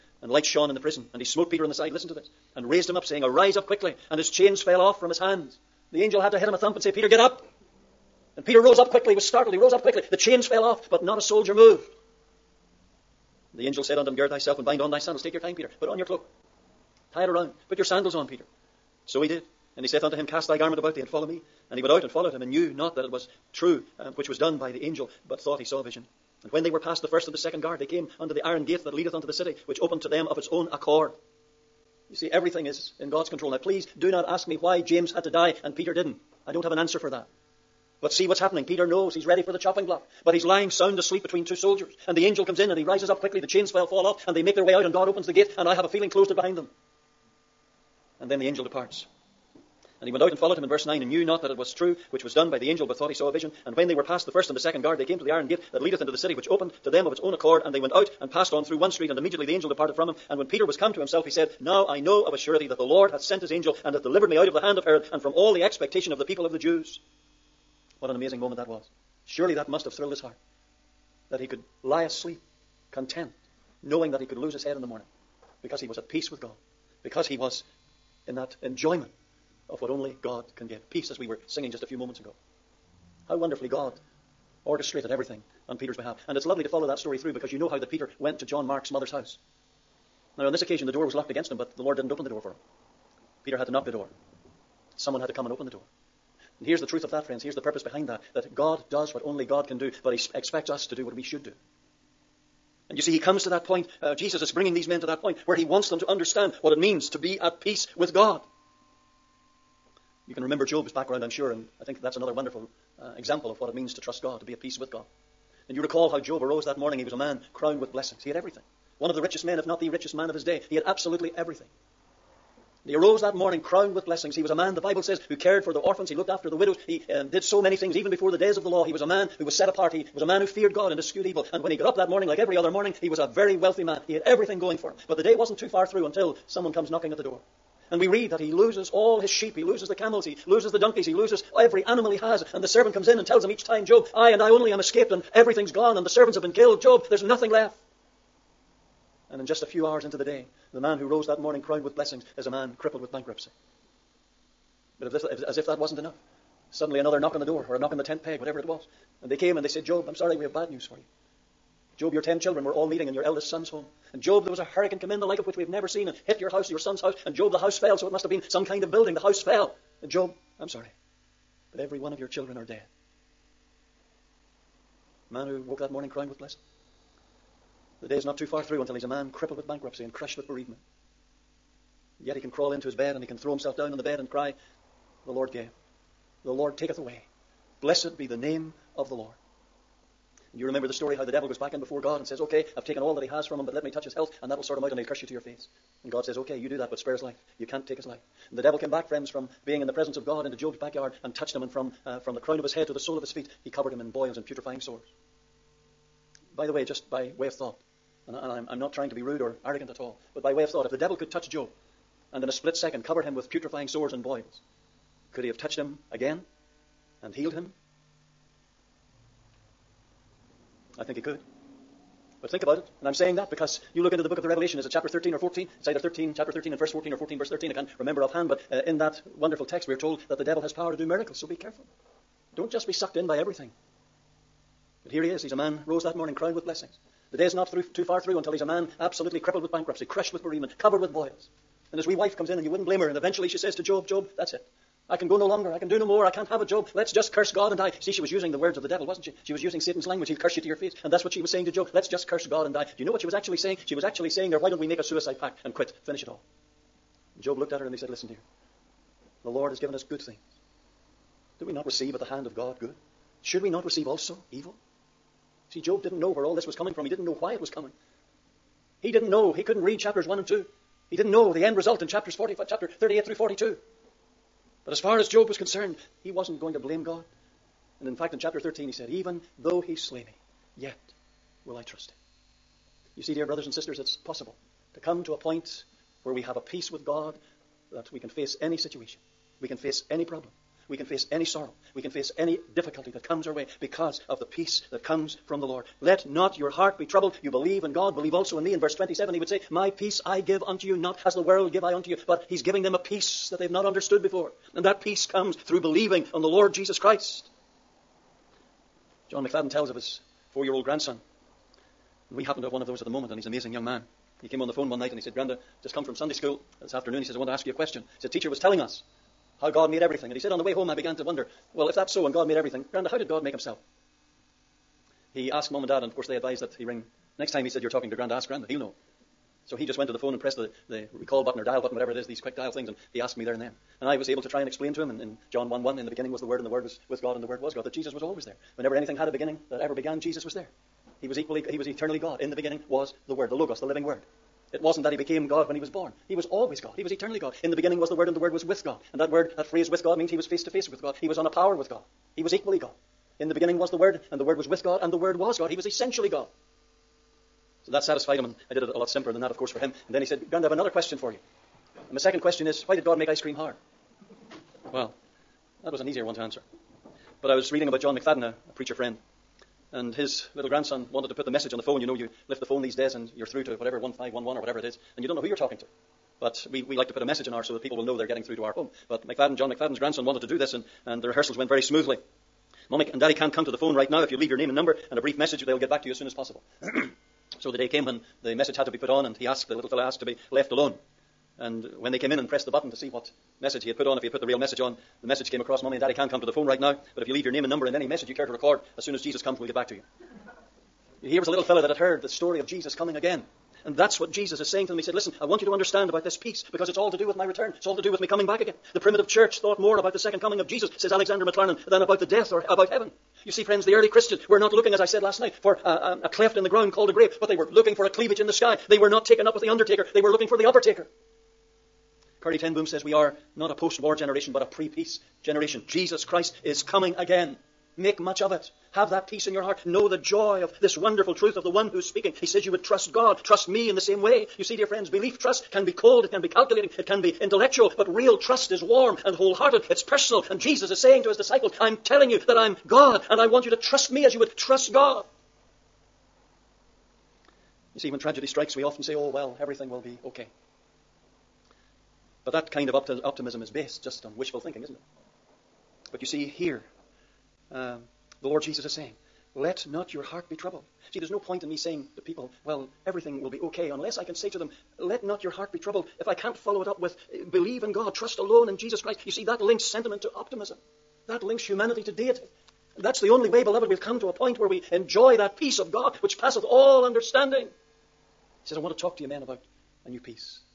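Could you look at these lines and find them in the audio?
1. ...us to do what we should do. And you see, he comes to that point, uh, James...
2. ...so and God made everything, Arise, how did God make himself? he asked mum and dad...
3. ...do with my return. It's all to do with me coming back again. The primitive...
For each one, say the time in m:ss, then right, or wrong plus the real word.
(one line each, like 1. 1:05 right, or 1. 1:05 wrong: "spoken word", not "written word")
1. 1:40 wrong: "Jesus", not "James"
2. 5:22 wrong: "Granda", not "Arise"
3. 6:47 right.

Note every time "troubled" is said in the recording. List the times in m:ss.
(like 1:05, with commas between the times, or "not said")
4:57, 7:40, 7:45.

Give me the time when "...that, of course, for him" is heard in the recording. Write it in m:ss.
5:59.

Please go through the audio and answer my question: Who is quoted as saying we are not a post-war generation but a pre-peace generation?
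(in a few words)
Corrie ten Boom.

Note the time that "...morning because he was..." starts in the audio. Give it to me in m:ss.
1:14.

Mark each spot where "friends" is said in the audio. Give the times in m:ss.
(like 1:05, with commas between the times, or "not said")
1:37, 3:19, 6:08, 6:53, 7:14.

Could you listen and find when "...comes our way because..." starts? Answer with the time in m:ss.
4:53.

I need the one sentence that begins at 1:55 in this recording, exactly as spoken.
And you recall how Job arose that morning.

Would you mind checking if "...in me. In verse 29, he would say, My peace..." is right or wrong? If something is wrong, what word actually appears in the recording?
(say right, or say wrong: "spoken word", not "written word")
wrong: "27", not "29".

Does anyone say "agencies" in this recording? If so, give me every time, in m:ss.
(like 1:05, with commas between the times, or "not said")
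not said.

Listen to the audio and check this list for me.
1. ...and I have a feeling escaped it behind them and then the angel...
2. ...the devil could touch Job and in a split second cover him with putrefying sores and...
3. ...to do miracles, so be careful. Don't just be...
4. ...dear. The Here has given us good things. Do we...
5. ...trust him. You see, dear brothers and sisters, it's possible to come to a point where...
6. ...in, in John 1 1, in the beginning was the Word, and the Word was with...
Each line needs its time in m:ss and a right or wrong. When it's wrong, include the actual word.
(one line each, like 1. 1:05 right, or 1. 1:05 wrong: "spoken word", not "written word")
1. 0:45 wrong: "closed", not "escaped"
2. 3:30 right
3. 3:50 right
4. 4:18 wrong: "Lord", not "Here"
5. 4:41 right
6. 5:35 right.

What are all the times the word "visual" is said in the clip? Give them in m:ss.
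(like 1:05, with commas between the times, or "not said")
not said.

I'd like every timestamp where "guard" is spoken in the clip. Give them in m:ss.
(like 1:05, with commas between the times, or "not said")
0:27, 0:54.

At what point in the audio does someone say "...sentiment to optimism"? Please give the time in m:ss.
7:49.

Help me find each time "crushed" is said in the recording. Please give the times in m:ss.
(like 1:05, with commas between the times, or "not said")
3:00, 4:00.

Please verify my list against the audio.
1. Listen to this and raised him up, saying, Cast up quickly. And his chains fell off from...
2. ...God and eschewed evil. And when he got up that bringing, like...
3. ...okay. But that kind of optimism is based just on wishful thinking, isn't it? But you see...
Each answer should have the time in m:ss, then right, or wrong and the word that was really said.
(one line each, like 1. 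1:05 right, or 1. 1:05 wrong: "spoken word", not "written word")
1. 0:01 wrong: "Arise", not "Cast"
2. 2:10 wrong: "morning", not "bringing"
3. 7:30 right.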